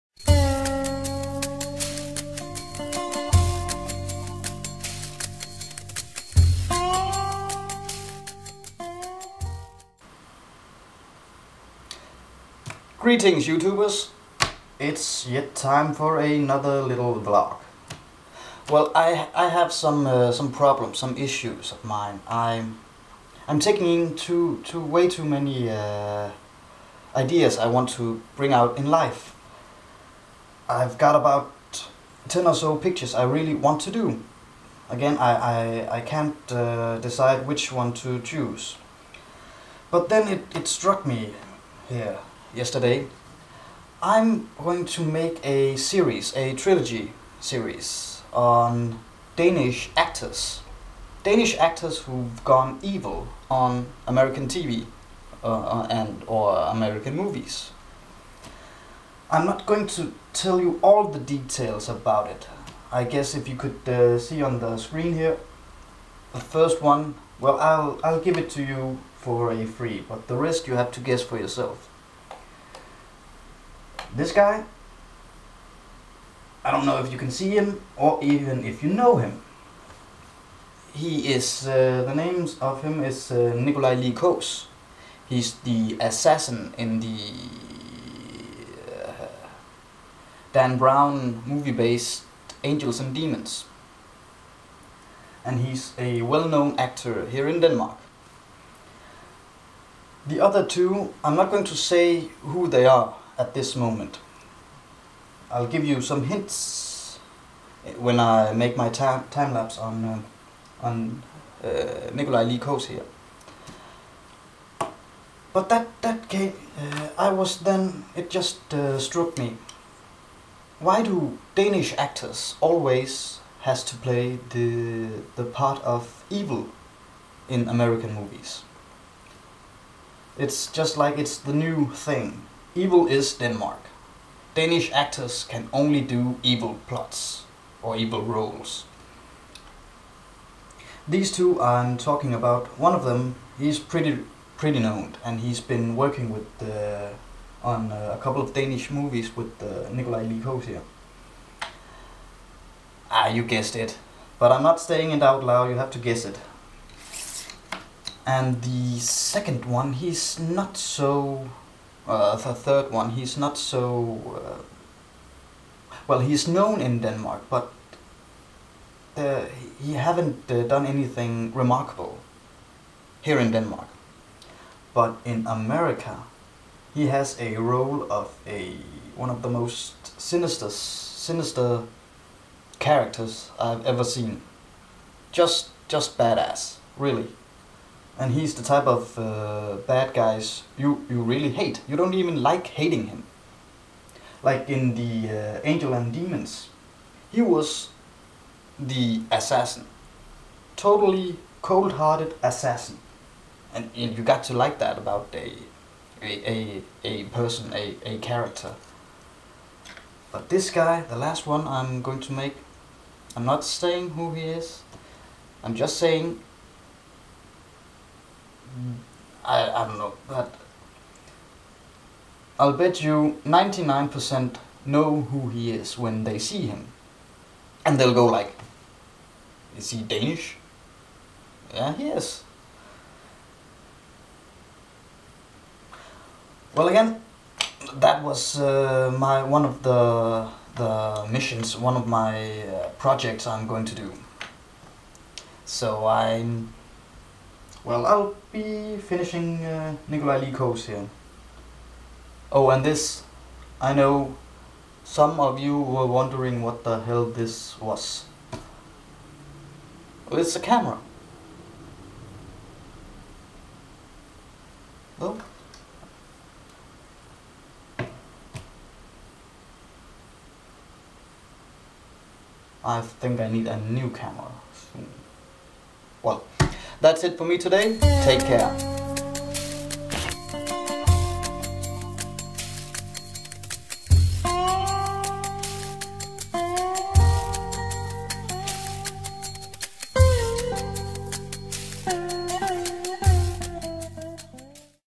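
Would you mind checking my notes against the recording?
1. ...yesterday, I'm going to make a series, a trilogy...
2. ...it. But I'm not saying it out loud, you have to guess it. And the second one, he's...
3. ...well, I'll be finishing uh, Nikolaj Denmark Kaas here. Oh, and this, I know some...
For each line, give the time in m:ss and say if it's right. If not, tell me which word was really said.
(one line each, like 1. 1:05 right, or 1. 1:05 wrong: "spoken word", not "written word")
1. 0:42 right
2. 2:33 right
3. 4:07 wrong: "Lee", not "Denmark".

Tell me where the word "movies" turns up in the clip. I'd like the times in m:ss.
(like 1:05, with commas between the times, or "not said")
0:57, 1:31, 2:08, 2:28.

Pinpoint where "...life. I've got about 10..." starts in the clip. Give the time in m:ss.
0:28.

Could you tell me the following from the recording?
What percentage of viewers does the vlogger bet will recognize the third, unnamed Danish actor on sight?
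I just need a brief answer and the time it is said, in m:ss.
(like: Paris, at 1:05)
99%, at 3:43.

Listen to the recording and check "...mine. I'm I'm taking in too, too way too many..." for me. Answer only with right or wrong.
right.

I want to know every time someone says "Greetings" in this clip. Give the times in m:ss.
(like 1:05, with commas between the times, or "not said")
0:13.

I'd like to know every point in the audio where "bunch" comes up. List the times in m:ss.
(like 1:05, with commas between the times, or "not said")
not said.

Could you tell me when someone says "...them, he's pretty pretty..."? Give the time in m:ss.
2:23.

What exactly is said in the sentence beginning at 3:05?
Just, just badass, really and he's the type of uh, bad guys you, you really hate.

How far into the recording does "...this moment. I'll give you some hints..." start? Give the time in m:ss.
1:43.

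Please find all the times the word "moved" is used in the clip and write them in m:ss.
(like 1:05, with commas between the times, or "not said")
not said.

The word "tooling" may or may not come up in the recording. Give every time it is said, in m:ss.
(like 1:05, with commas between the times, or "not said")
not said.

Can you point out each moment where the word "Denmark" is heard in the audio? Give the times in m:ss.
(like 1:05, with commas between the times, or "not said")
1:37, 2:13, 2:46, 2:53.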